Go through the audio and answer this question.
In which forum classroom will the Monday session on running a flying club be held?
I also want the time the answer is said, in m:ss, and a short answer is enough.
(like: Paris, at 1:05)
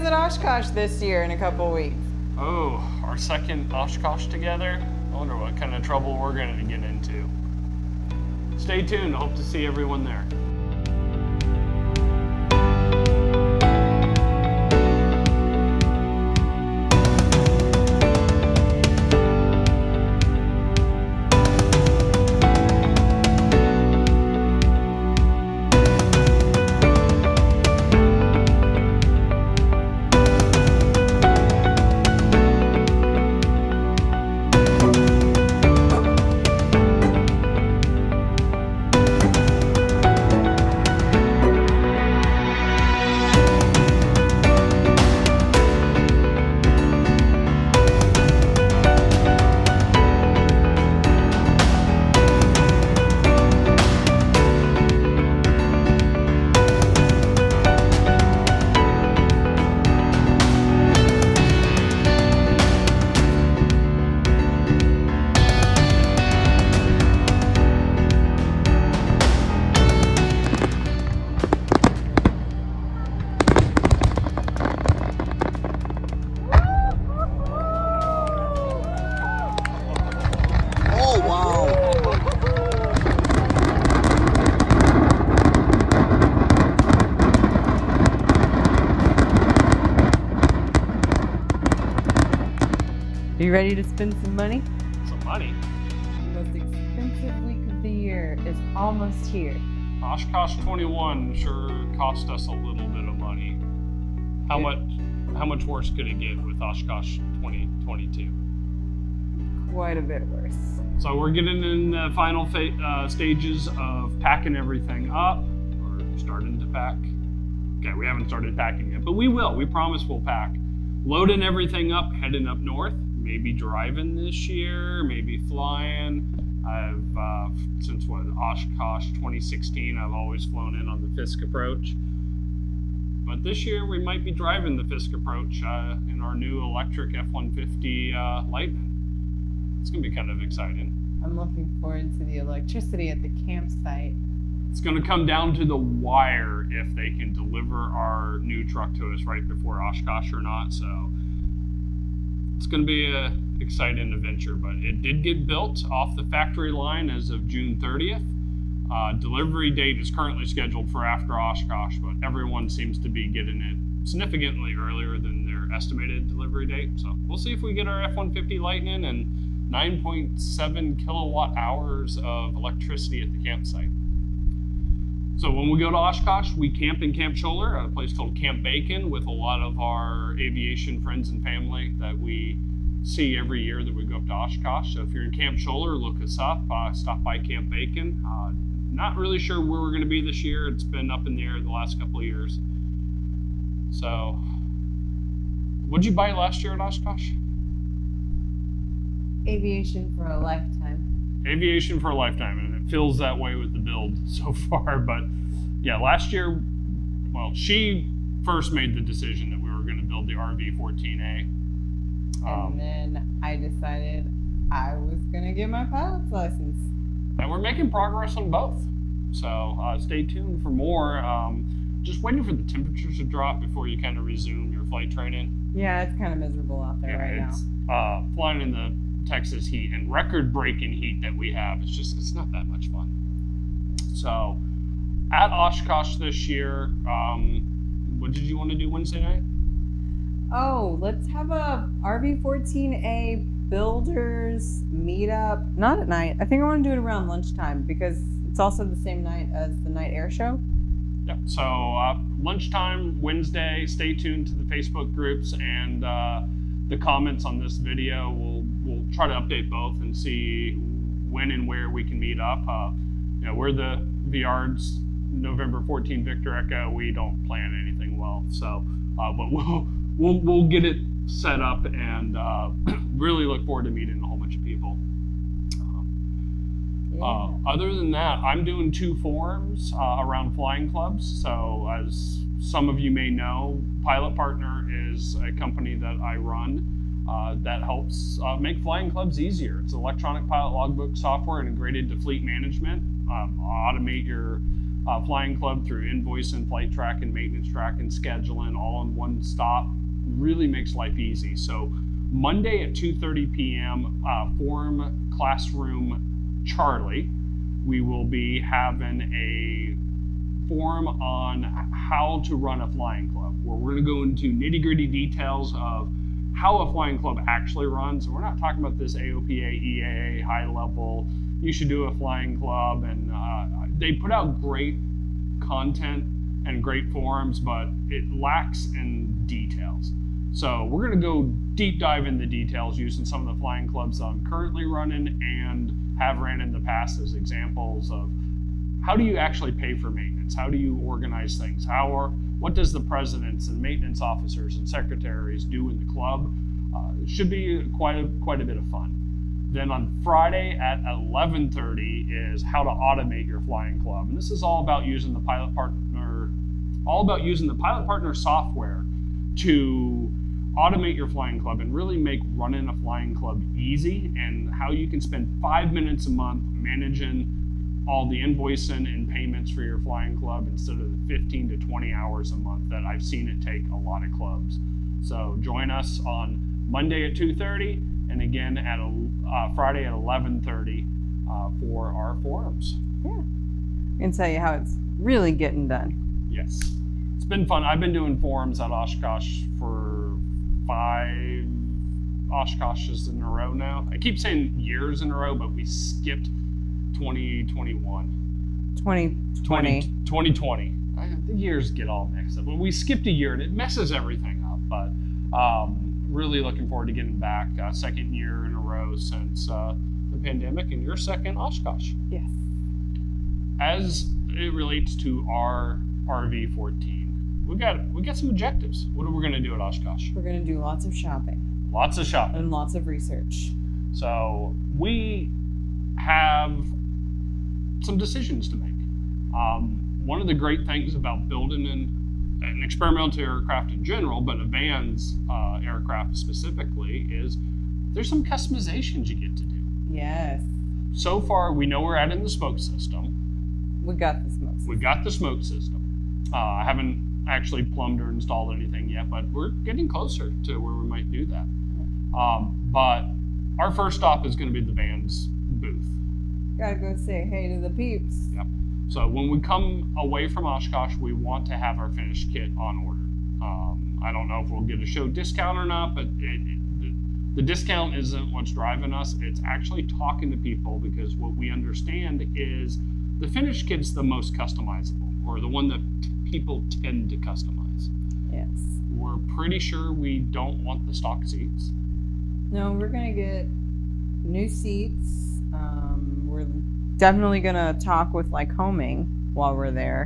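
Charlie, at 5:06.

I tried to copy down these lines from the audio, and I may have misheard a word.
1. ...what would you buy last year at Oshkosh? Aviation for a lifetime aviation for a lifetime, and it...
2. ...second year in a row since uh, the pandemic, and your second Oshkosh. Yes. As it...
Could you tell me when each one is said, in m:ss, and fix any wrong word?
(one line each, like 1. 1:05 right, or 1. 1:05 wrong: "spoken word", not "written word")
1. 3:15 right
2. 6:47 right.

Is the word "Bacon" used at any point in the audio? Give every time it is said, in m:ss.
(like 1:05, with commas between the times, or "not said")
2:58, 3:07.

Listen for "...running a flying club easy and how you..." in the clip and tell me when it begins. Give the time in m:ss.
6:02.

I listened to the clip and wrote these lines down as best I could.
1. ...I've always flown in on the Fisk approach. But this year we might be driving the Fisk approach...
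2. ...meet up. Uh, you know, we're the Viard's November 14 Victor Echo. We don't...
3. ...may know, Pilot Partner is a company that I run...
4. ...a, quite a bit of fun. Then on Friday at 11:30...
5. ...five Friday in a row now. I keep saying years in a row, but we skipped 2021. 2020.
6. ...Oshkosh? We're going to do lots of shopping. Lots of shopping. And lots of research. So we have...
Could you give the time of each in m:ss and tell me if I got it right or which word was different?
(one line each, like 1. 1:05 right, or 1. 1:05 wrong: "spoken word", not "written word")
1. 2:10 right
2. 4:22 right
3. 4:43 right
4. 5:48 right
5. 6:30 wrong: "Oshkoshes", not "Friday"
6. 6:59 right.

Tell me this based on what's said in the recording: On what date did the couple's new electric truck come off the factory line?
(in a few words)
June 30th.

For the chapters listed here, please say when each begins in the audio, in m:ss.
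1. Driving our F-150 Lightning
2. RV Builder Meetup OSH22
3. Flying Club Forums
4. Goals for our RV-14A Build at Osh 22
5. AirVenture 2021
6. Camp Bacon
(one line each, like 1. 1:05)
1. 1:33
2. 3:55
3. 4:38
4. 6:54
5. 3:19
6. 2:55.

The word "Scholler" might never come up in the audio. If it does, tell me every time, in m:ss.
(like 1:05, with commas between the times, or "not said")
2:57, 3:05.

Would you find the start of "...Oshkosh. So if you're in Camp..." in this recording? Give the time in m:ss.
3:04.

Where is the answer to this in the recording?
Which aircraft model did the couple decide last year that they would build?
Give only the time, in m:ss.
3:30.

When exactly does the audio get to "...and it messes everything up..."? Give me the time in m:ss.
6:43.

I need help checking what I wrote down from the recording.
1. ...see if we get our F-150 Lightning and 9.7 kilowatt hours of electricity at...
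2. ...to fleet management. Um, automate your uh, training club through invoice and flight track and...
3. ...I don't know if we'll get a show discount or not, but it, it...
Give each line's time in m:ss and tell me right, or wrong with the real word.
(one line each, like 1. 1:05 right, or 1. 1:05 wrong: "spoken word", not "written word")
1. 2:47 right
2. 4:52 wrong: "flying", not "training"
3. 7:44 right.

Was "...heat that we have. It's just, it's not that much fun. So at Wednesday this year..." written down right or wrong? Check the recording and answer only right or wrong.
wrong.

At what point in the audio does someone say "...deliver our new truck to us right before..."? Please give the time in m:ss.
2:27.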